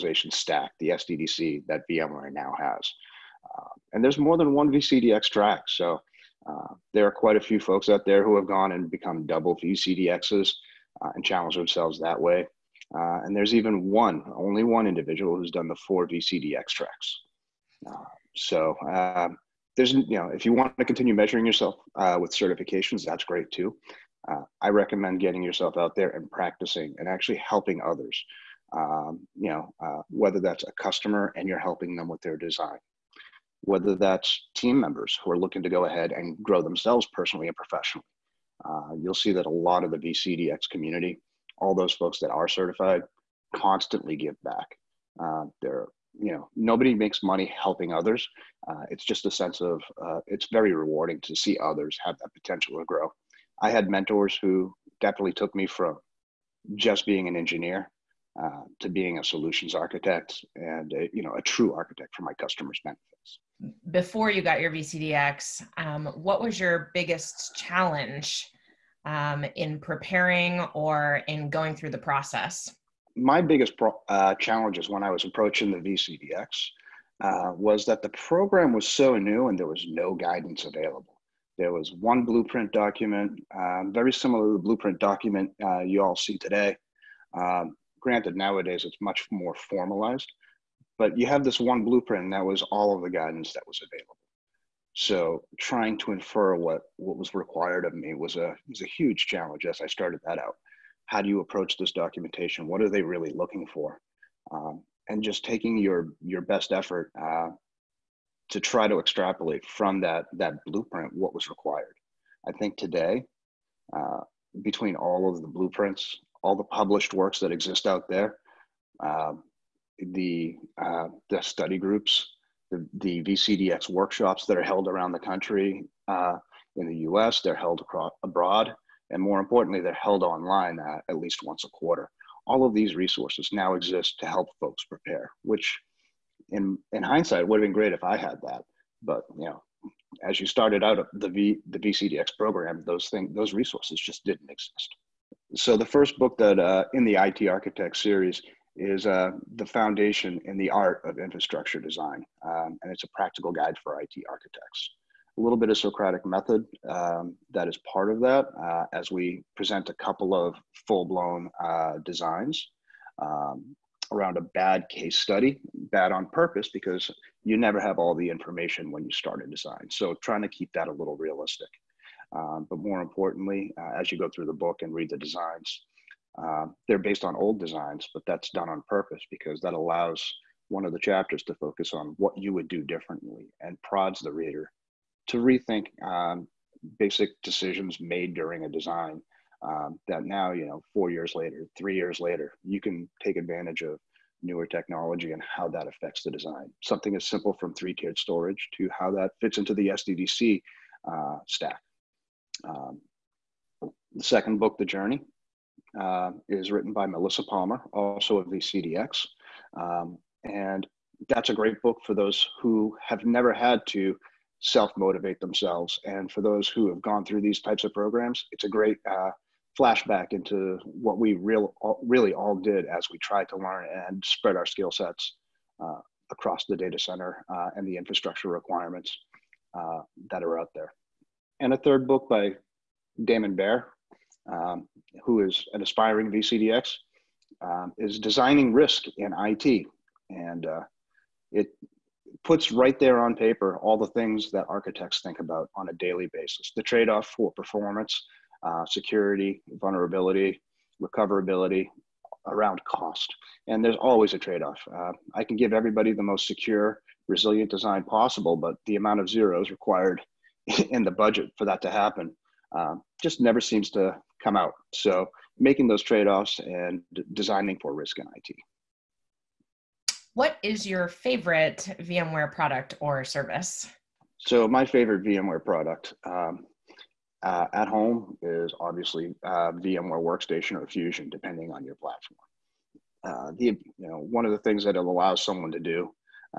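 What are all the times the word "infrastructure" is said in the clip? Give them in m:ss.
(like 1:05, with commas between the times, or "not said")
2:31, 3:47.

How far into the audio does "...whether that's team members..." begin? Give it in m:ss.
0:33.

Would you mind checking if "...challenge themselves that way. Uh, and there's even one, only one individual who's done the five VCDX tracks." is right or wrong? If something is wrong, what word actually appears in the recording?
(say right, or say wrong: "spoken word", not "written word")
wrong: "four", not "five".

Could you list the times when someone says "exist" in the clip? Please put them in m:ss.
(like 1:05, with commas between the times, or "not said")
1:57, 2:13, 2:24.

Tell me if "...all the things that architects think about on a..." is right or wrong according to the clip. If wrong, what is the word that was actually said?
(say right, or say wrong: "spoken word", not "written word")
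right.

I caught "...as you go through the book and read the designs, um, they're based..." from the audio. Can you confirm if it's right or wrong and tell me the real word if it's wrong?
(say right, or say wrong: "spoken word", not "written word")
right.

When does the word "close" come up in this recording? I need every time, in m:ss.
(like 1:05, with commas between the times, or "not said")
not said.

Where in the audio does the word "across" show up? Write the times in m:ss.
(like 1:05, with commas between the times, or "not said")
2:07, 3:46.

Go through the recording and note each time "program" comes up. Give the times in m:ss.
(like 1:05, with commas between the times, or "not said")
1:18, 2:22, 3:37.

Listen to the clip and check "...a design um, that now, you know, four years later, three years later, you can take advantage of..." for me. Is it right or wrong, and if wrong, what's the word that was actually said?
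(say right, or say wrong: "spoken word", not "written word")
right.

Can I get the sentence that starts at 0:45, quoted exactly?
Uh, they're you know nobody makes money helping others.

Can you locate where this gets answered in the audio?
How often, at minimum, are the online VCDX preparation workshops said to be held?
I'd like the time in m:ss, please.
2:11.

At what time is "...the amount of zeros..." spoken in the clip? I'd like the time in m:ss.
4:18.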